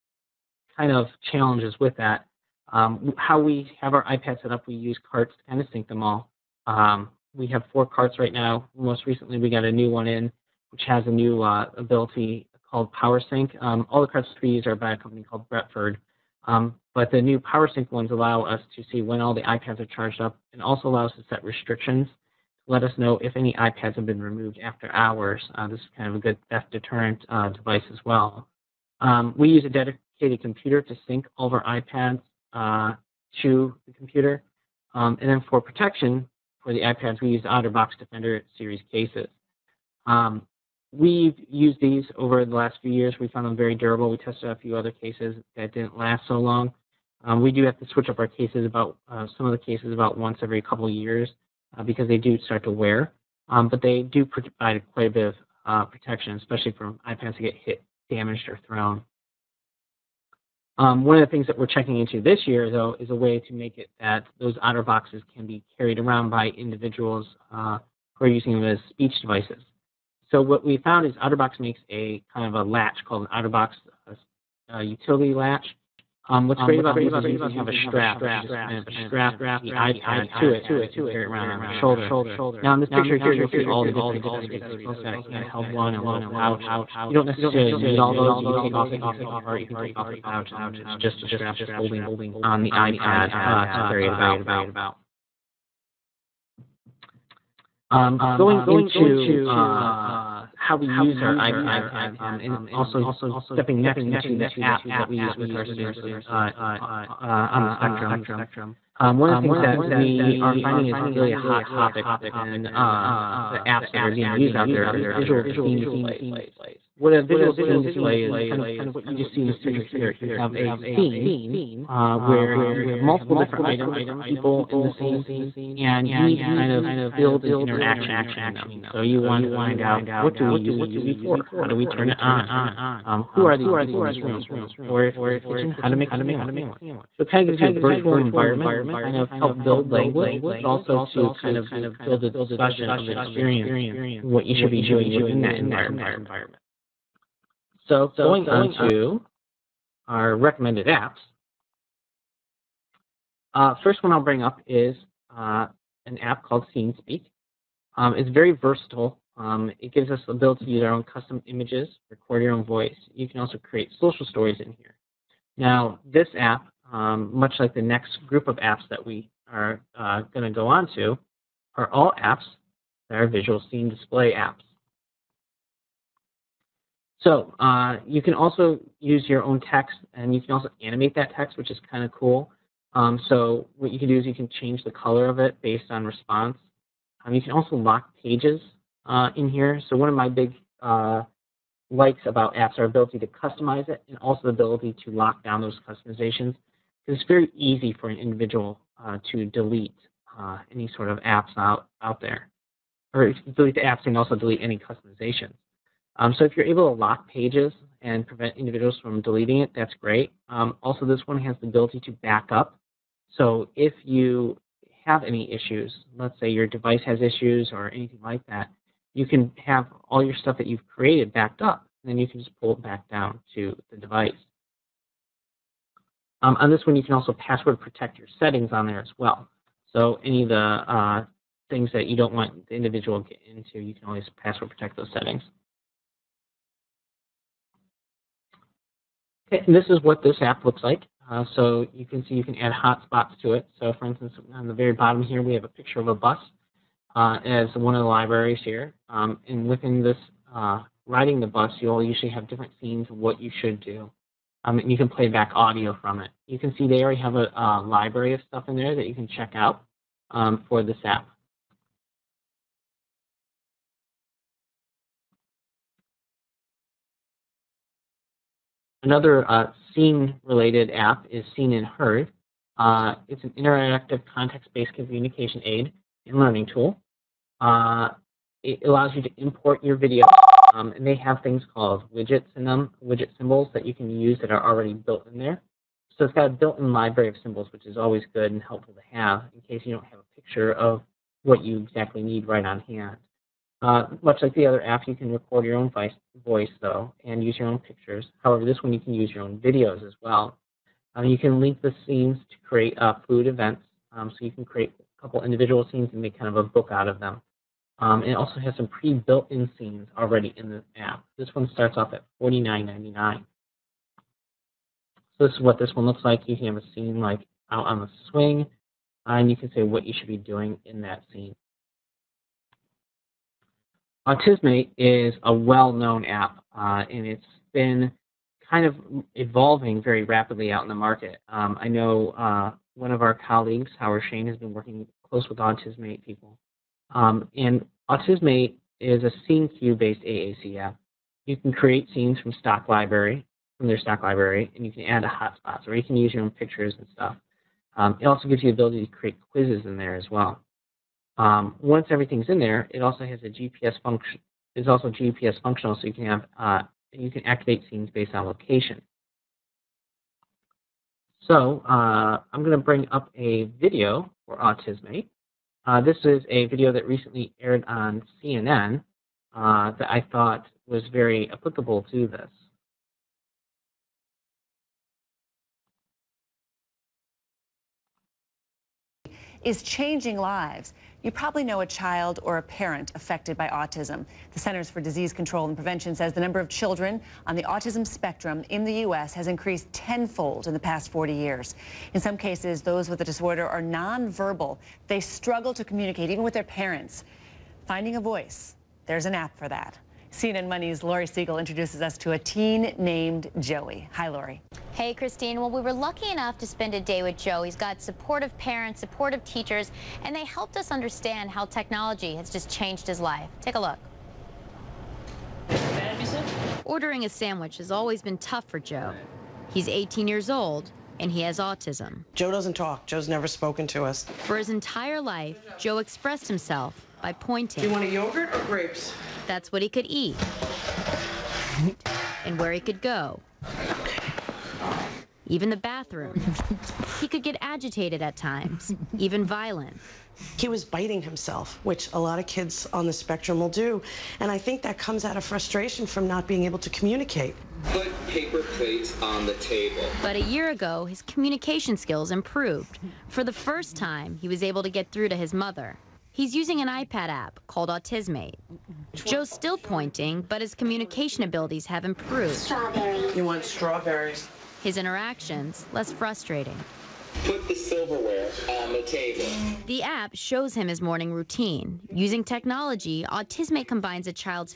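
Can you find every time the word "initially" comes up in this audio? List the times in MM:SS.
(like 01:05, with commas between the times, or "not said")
not said.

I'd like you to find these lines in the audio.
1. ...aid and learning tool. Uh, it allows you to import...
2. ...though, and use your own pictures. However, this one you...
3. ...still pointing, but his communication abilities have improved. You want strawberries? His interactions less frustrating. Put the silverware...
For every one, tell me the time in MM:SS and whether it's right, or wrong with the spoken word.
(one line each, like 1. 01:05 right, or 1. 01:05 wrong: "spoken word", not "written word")
1. 04:35 right
2. 04:56 right
3. 07:39 right.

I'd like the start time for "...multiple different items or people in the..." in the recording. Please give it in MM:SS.
02:02.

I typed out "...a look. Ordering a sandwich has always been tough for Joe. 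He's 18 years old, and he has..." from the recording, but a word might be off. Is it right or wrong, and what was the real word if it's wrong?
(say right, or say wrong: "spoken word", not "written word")
right.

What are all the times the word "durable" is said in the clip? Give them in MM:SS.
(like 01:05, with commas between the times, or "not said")
00:43.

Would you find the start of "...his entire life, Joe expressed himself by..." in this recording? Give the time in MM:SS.
07:04.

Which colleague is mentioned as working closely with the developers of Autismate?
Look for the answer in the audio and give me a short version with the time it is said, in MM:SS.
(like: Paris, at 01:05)
Howard Shane, at 05:33.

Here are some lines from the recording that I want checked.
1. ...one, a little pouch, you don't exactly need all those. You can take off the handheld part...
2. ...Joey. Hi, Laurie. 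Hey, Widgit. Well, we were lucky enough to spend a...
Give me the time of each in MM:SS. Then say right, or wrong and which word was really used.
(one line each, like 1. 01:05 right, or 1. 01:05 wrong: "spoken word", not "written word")
1. 01:25 wrong: "necessarily", not "exactly"
2. 06:43 wrong: "Christine", not "Widgit".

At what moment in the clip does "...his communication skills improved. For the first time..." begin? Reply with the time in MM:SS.
07:31.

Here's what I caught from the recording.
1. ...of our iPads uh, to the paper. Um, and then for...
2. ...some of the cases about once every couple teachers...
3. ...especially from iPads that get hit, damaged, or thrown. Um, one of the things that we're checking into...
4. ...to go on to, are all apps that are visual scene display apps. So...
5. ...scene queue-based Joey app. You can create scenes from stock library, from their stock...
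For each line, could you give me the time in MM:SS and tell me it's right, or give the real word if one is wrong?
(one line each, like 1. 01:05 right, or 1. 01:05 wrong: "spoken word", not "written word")
1. 00:31 wrong: "computer", not "paper"
2. 00:49 wrong: "years", not "teachers"
3. 00:56 right
4. 02:50 right
5. 05:39 wrong: "AAC", not "Joey".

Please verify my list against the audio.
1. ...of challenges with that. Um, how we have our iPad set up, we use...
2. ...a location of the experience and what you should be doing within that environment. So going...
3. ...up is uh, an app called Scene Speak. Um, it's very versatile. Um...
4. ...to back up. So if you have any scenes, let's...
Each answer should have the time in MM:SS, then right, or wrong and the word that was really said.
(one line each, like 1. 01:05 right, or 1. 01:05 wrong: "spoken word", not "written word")
1. 00:00 right
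2. 02:22 wrong: "discussion", not "location"
3. 02:34 right
4. 03:32 wrong: "issues", not "scenes".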